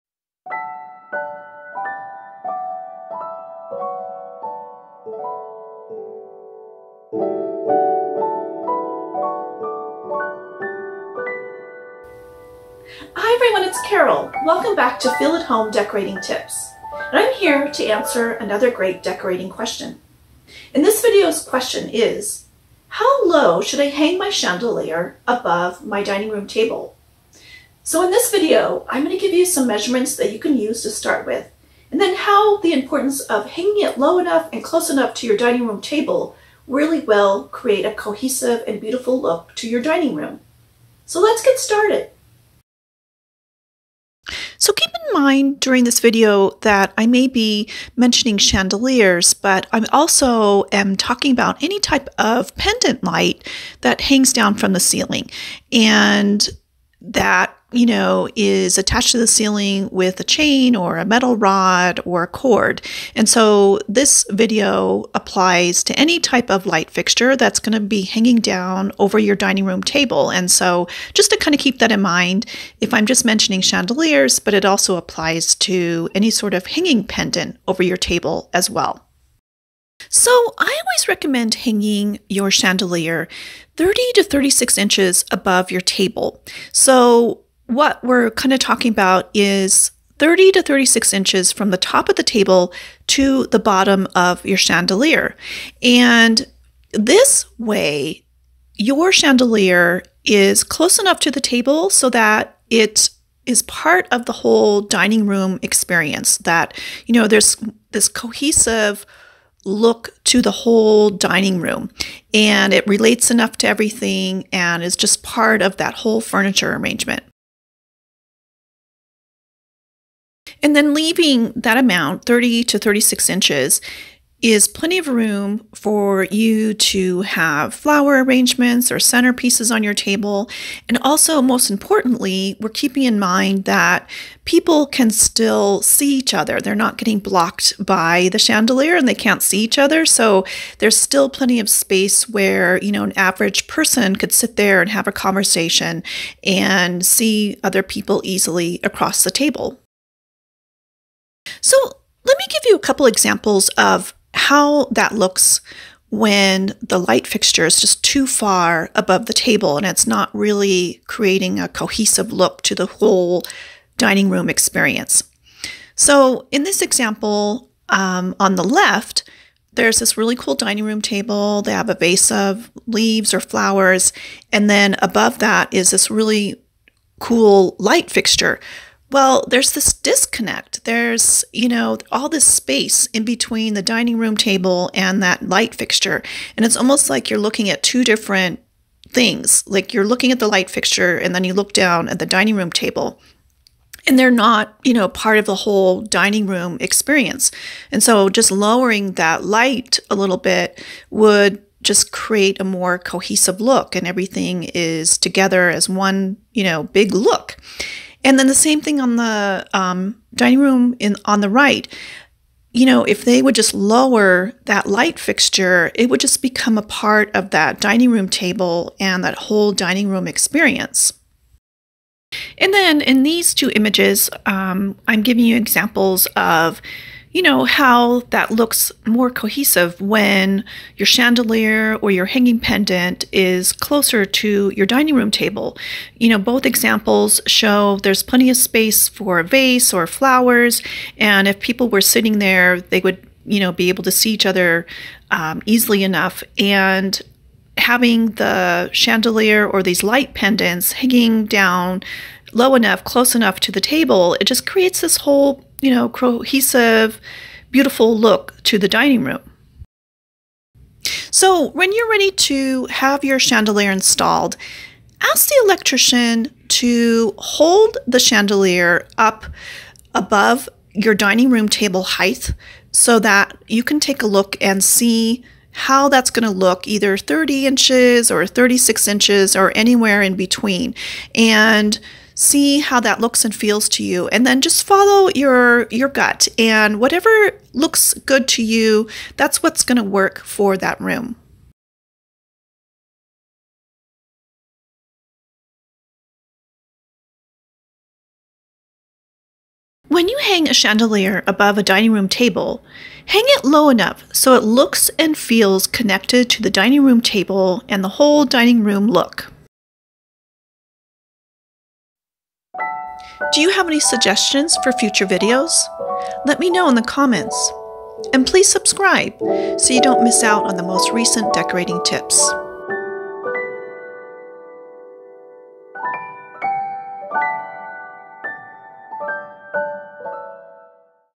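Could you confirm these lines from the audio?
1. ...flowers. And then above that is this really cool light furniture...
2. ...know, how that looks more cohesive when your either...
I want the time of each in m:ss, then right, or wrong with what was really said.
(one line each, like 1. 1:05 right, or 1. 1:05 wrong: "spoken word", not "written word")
1. 2:53 wrong: "fixture", not "furniture"
2. 3:47 wrong: "chandelier", not "either".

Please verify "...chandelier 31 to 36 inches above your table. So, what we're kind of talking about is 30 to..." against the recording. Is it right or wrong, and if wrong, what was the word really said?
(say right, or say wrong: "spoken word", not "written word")
wrong: "30", not "31".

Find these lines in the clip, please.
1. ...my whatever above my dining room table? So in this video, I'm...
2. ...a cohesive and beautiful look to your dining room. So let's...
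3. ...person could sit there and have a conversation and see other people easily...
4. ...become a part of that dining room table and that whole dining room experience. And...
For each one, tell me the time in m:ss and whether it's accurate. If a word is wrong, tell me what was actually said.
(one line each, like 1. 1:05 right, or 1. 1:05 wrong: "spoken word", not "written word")
1. 0:24 wrong: "chandelier", not "whatever"
2. 0:37 right
3. 2:23 right
4. 3:36 right.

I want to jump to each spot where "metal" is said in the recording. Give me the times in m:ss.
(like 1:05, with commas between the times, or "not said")
1:01.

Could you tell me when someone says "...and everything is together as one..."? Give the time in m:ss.
3:23.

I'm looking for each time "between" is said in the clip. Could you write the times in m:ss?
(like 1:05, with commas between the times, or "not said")
3:03, 4:40.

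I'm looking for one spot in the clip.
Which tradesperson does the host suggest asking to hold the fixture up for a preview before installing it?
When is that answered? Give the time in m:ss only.
4:25.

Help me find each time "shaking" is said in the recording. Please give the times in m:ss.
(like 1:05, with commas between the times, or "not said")
not said.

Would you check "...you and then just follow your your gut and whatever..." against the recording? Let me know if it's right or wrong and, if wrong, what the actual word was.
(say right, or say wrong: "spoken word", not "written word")
right.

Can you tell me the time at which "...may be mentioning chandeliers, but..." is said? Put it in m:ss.
0:47.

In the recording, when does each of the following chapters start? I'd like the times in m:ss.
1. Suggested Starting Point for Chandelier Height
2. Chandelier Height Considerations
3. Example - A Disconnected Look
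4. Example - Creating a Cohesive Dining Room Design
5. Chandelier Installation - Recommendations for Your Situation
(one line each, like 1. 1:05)
1. 1:20
2. 2:00
3. 2:31
4. 3:40
5. 4:20.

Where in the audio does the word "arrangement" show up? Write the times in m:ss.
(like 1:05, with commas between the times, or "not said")
1:56, 2:08.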